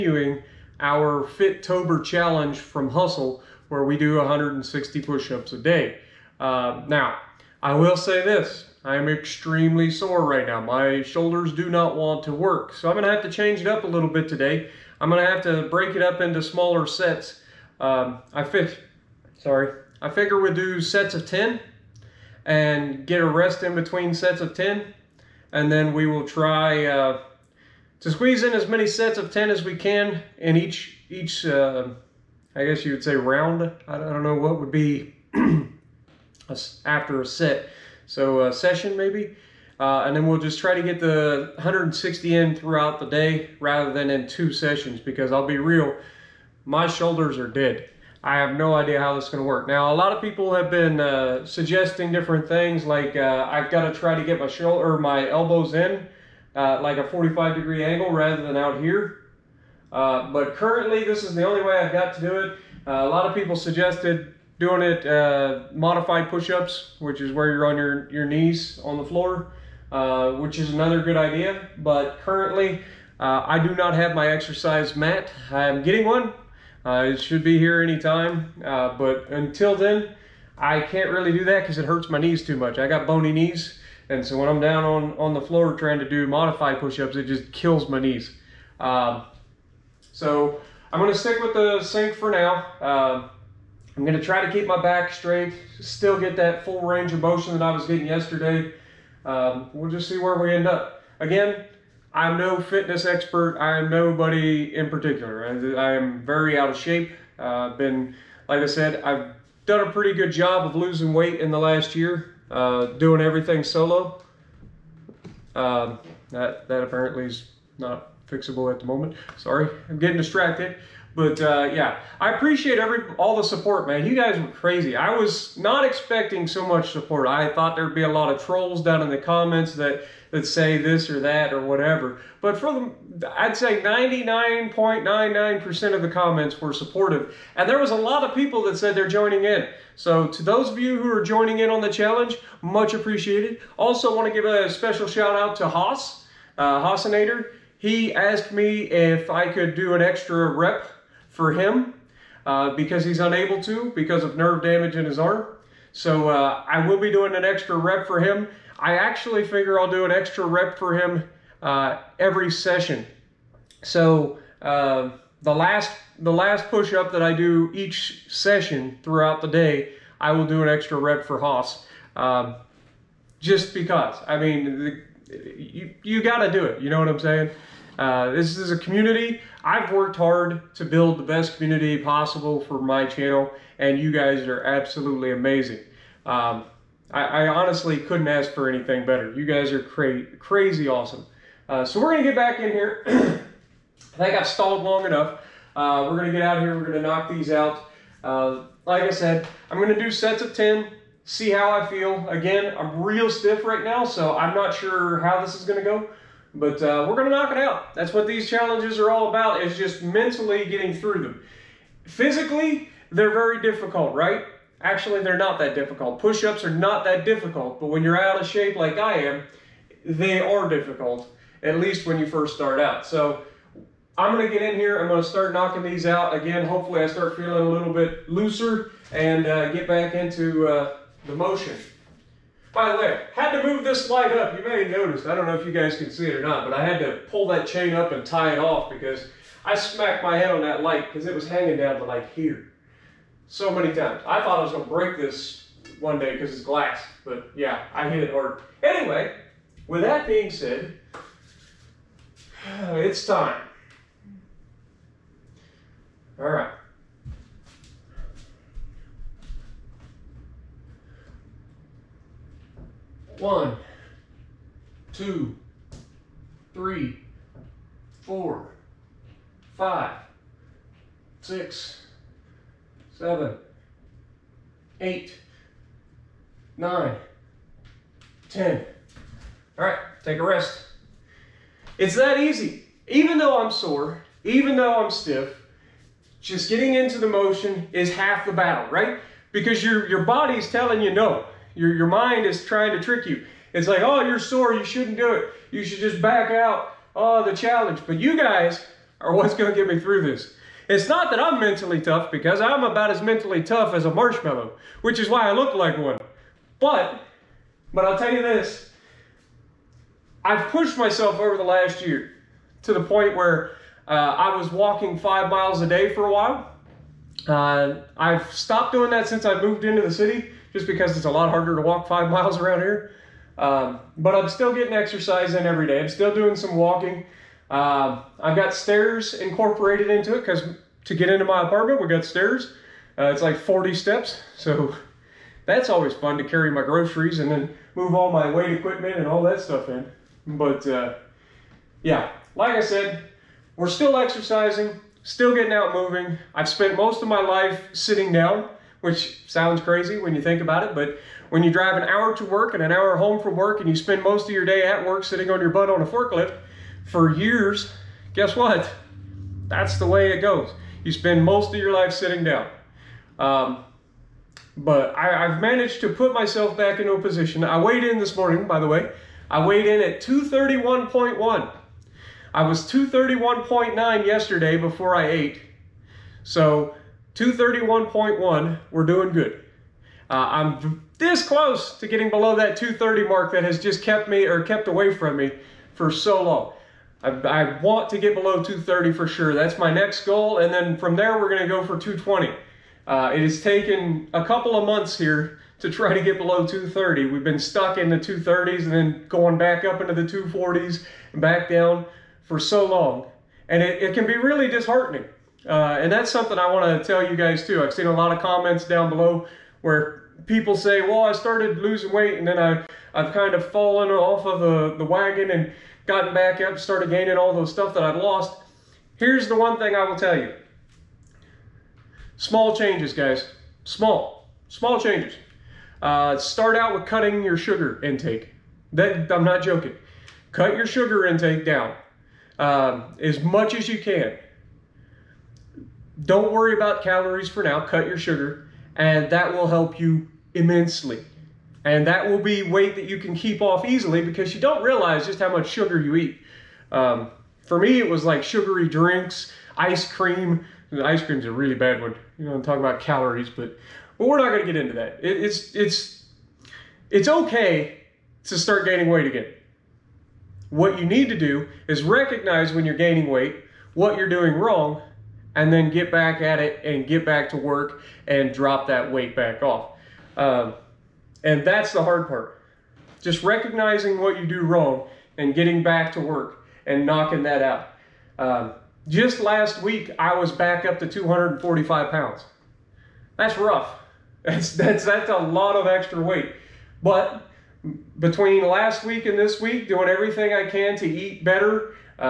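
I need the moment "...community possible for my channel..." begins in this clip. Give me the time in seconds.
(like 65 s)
181 s.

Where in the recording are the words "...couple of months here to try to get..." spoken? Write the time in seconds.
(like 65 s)
394 s.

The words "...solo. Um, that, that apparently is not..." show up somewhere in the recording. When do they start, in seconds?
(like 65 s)
113 s.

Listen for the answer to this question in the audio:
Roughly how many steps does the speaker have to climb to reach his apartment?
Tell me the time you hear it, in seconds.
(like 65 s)
333 s.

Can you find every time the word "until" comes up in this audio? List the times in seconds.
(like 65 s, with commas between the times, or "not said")
79 s.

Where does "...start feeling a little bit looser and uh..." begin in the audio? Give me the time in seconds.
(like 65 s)
227 s.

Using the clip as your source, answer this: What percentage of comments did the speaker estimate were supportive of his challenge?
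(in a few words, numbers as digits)
99.99%.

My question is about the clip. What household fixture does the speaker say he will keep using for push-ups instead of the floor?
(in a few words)
the sink.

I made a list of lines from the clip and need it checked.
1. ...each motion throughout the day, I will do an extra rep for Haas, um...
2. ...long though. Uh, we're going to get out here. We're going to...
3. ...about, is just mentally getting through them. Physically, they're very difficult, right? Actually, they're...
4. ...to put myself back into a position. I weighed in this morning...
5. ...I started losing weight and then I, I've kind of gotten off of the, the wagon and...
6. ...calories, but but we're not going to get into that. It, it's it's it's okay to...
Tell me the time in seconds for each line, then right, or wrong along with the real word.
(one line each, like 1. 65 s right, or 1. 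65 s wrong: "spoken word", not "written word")
1. 167 s wrong: "session", not "motion"
2. 194 s wrong: "enough", not "though"
3. 209 s right
4. 366 s right
5. 411 s wrong: "fallen", not "gotten"
6. 452 s right.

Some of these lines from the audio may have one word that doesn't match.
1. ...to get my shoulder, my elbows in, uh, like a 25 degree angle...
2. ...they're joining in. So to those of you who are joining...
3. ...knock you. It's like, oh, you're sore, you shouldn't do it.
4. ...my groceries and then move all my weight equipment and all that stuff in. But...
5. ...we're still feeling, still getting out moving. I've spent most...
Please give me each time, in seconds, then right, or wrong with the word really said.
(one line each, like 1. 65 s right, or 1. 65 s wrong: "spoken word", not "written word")
1. 54 s wrong: "45", not "25"
2. 138 s right
3. 293 s wrong: "trick", not "knock"
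4. 336 s right
5. 343 s wrong: "exercising", not "feeling".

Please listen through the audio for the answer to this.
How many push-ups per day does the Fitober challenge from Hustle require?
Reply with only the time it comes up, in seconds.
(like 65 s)
4 s.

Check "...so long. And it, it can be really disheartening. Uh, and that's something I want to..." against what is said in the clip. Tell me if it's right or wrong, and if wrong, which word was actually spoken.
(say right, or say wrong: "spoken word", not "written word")
right.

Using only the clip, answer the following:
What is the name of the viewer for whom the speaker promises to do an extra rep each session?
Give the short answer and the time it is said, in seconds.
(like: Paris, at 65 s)
Haasinator, at 146 s.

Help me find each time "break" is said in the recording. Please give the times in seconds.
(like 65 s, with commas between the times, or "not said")
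15 s, 244 s.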